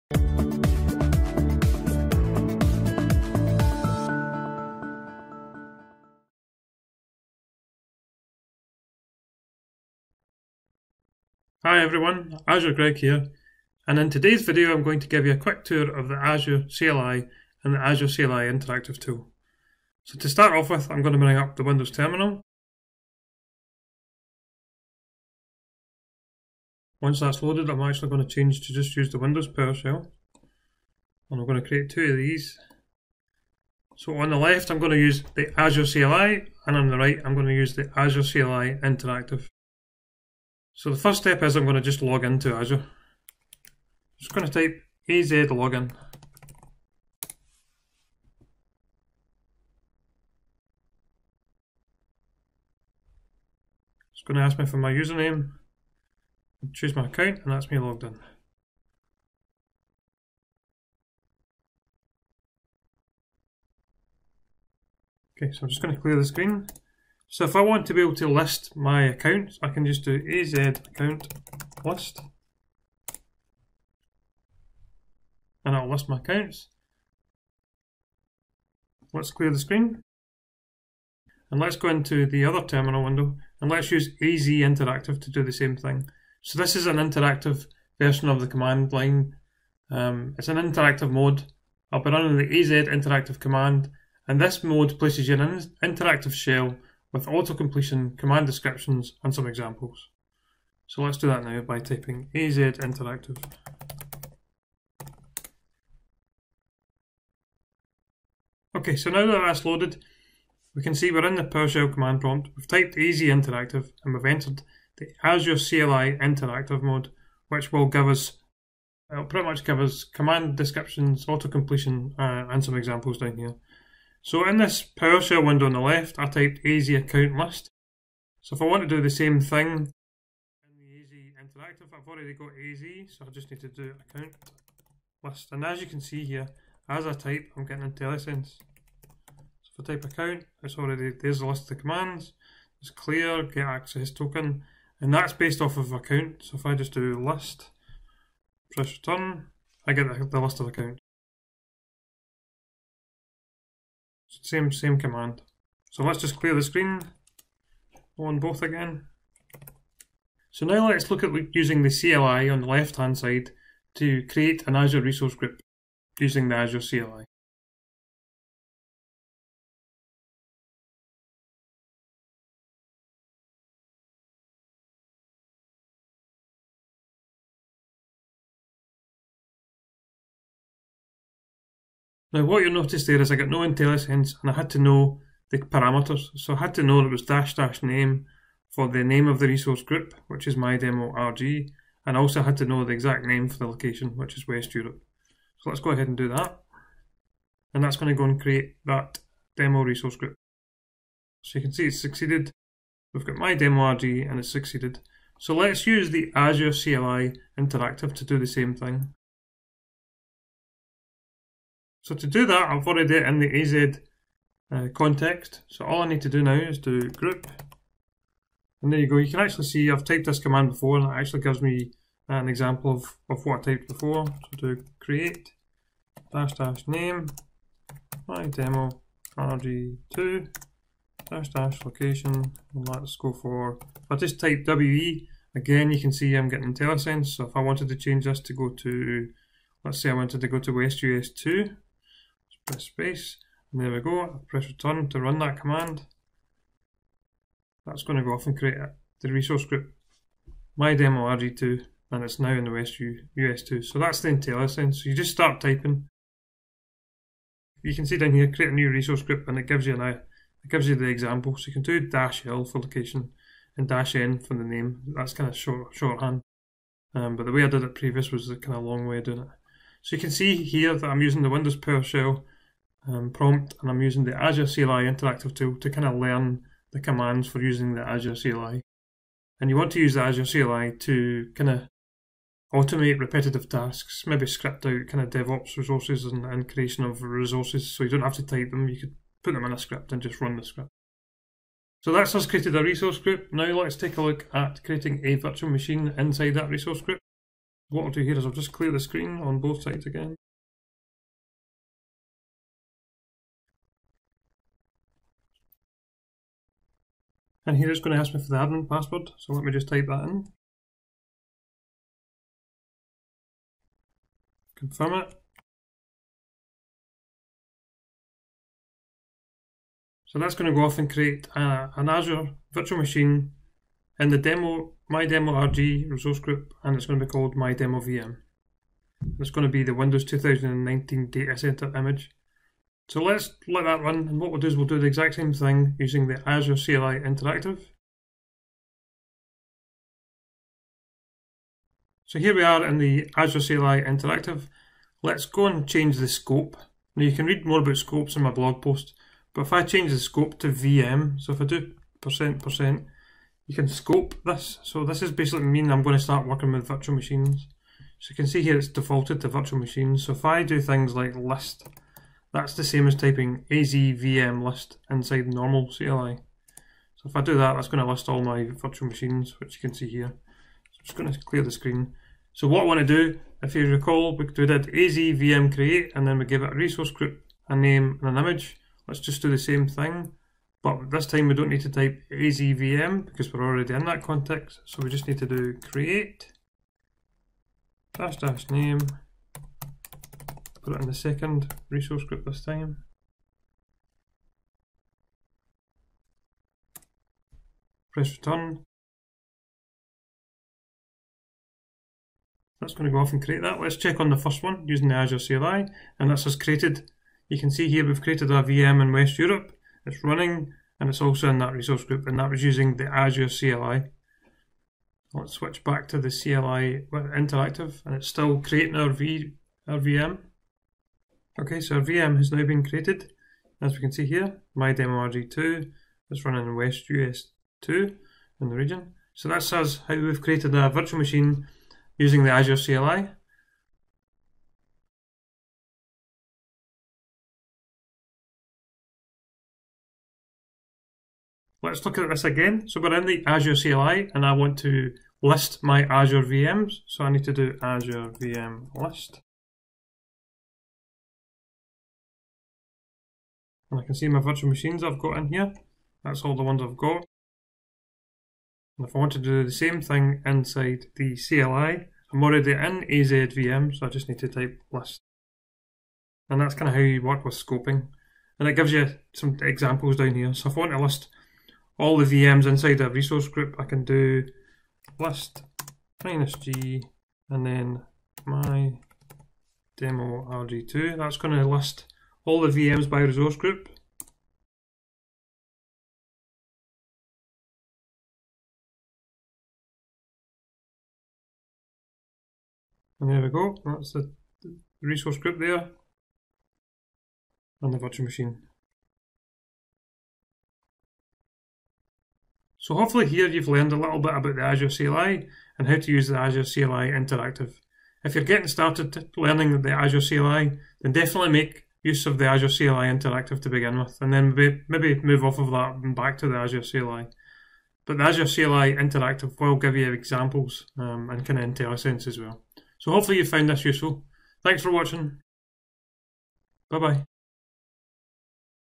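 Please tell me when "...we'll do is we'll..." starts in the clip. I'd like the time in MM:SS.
05:34.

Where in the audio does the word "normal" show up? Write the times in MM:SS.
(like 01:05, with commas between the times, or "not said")
06:05.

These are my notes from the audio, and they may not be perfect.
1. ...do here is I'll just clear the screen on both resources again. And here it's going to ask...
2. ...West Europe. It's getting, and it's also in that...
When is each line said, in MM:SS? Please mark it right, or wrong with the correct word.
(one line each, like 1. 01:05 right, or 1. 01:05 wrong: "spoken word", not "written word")
1. 04:58 wrong: "sides", not "resources"
2. 06:49 wrong: "running", not "getting".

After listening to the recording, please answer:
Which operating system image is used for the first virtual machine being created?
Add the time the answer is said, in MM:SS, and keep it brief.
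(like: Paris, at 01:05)
Windows 2019 Datacenter, at 05:29.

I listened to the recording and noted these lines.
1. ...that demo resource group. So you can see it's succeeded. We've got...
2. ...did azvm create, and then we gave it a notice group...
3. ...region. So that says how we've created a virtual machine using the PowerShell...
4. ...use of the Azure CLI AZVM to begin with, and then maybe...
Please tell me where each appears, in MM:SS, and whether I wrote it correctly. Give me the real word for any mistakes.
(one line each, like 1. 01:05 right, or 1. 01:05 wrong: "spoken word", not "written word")
1. 03:18 right
2. 06:14 wrong: "resource", not "notice"
3. 07:08 wrong: "Azure", not "PowerShell"
4. 08:32 wrong: "Interactive", not "AZVM".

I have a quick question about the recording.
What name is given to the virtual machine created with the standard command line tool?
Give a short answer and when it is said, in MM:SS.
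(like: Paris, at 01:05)
my demo VM, at 05:27.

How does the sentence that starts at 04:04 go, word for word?
i return to run that command.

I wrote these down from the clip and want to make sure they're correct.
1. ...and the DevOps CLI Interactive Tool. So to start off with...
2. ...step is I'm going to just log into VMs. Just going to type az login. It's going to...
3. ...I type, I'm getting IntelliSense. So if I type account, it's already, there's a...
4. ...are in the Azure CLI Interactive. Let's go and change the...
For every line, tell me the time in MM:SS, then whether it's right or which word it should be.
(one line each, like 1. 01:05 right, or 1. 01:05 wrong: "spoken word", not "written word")
1. 00:17 wrong: "Azure", not "DevOps"
2. 00:41 wrong: "Azure", not "VMs"
3. 02:17 right
4. 05:42 right.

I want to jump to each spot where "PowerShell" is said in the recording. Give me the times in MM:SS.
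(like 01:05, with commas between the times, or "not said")
00:29, 01:51, 02:04, 04:31.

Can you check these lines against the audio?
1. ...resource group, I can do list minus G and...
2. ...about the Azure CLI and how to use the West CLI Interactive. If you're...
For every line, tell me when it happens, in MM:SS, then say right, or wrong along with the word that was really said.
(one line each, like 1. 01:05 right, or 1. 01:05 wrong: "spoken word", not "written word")
1. 07:53 right
2. 08:24 wrong: "Azure", not "West".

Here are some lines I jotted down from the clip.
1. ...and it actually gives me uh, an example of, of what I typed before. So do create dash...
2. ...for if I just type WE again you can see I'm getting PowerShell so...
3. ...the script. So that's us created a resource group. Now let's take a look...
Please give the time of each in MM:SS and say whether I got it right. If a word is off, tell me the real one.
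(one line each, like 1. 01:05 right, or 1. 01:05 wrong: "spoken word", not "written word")
1. 03:40 right
2. 03:53 wrong: "IntelliSense", not "PowerShell"
3. 04:50 right.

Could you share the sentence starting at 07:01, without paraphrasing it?
Okay, so our VM has now been created.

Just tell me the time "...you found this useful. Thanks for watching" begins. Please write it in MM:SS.
08:43.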